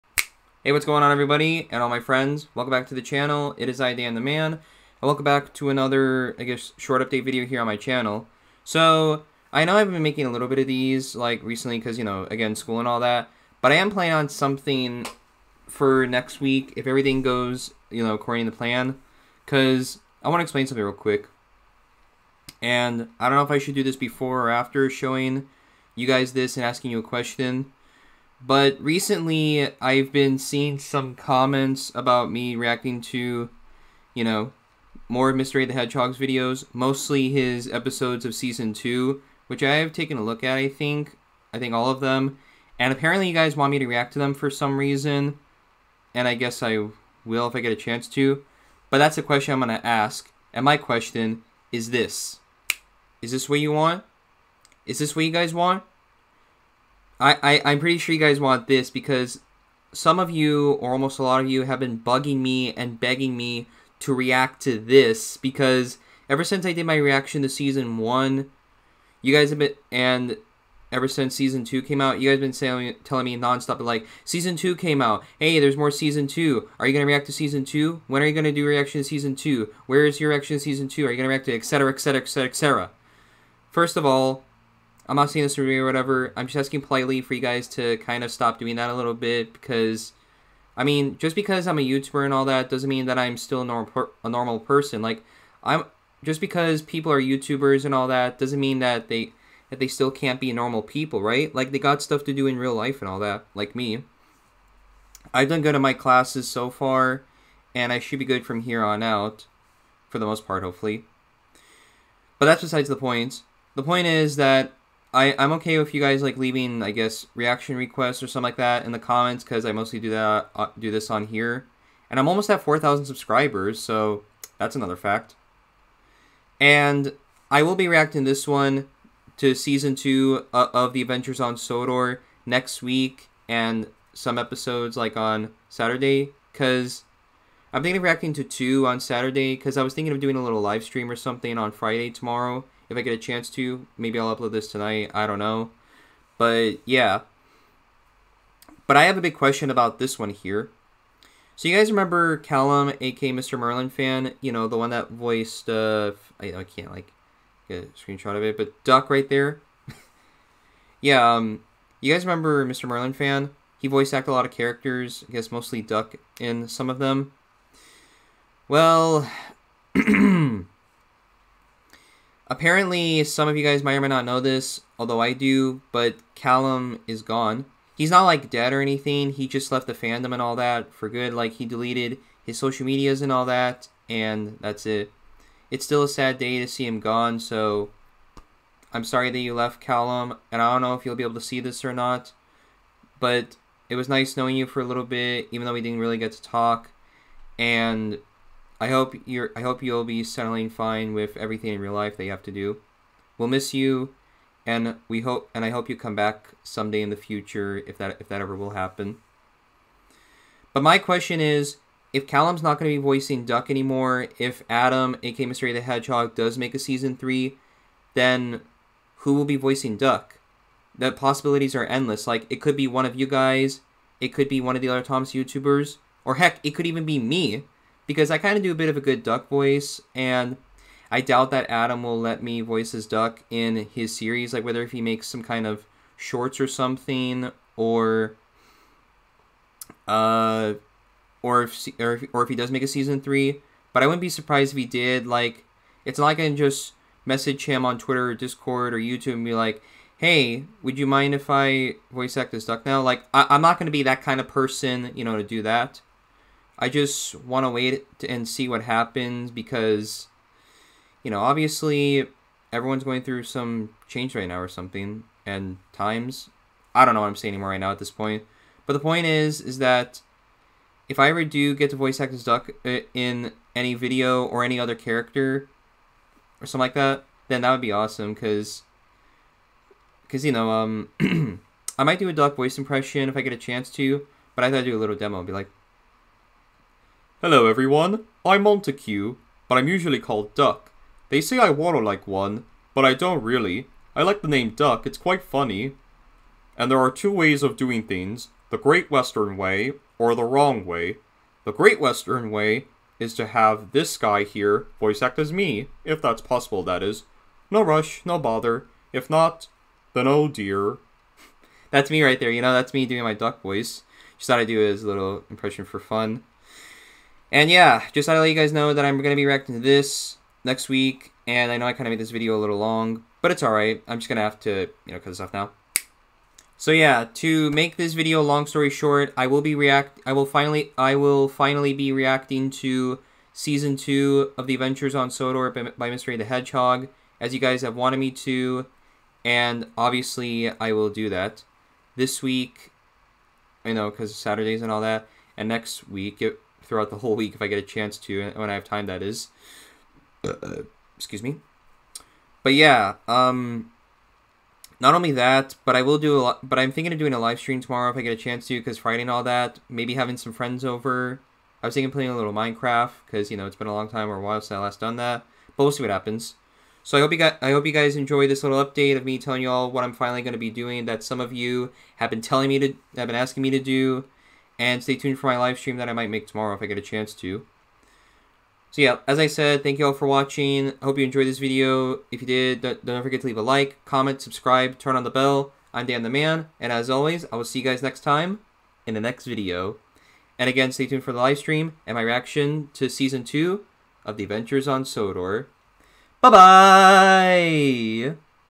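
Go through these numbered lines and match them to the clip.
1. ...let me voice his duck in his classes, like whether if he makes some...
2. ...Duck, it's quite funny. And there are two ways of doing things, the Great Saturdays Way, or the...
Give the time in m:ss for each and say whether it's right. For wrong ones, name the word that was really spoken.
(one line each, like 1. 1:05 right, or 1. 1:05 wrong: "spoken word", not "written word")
1. 3:52 wrong: "series", not "classes"
2. 4:54 wrong: "Western", not "Saturdays".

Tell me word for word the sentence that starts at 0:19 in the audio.
Because I want to explain something real quick.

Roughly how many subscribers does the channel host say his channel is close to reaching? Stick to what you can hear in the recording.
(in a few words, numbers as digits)
4,000.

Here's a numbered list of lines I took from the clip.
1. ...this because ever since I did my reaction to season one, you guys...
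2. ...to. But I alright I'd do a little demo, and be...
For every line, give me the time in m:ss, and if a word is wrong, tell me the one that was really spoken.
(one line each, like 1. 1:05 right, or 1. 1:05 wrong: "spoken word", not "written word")
1. 1:04 right
2. 4:43 wrong: "thought", not "alright".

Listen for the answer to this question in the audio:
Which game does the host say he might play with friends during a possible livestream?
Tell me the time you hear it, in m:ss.
6:02.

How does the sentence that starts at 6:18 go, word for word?
So yeah, as I said, thank you all for watching.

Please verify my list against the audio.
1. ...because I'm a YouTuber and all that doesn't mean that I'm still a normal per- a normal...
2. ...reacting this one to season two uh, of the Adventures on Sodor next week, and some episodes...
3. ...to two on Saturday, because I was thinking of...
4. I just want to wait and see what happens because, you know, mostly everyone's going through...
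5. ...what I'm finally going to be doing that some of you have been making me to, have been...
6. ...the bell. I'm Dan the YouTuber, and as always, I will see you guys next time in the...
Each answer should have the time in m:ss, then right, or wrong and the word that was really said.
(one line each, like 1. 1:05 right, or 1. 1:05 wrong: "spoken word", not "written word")
1. 1:31 right
2. 2:07 right
3. 2:18 right
4. 4:16 wrong: "obviously", not "mostly"
5. 6:09 wrong: "telling", not "making"
6. 6:25 wrong: "Man", not "YouTuber".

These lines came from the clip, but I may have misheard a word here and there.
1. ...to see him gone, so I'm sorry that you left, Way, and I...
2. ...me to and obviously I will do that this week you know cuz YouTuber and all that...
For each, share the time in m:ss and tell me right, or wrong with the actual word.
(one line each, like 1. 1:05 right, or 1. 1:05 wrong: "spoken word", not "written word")
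1. 3:06 wrong: "Callum", not "Way"
2. 5:38 wrong: "Saturdays", not "YouTuber".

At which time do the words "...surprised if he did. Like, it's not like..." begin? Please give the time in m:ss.
4:04.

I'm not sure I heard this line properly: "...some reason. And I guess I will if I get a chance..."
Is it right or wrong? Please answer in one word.
right.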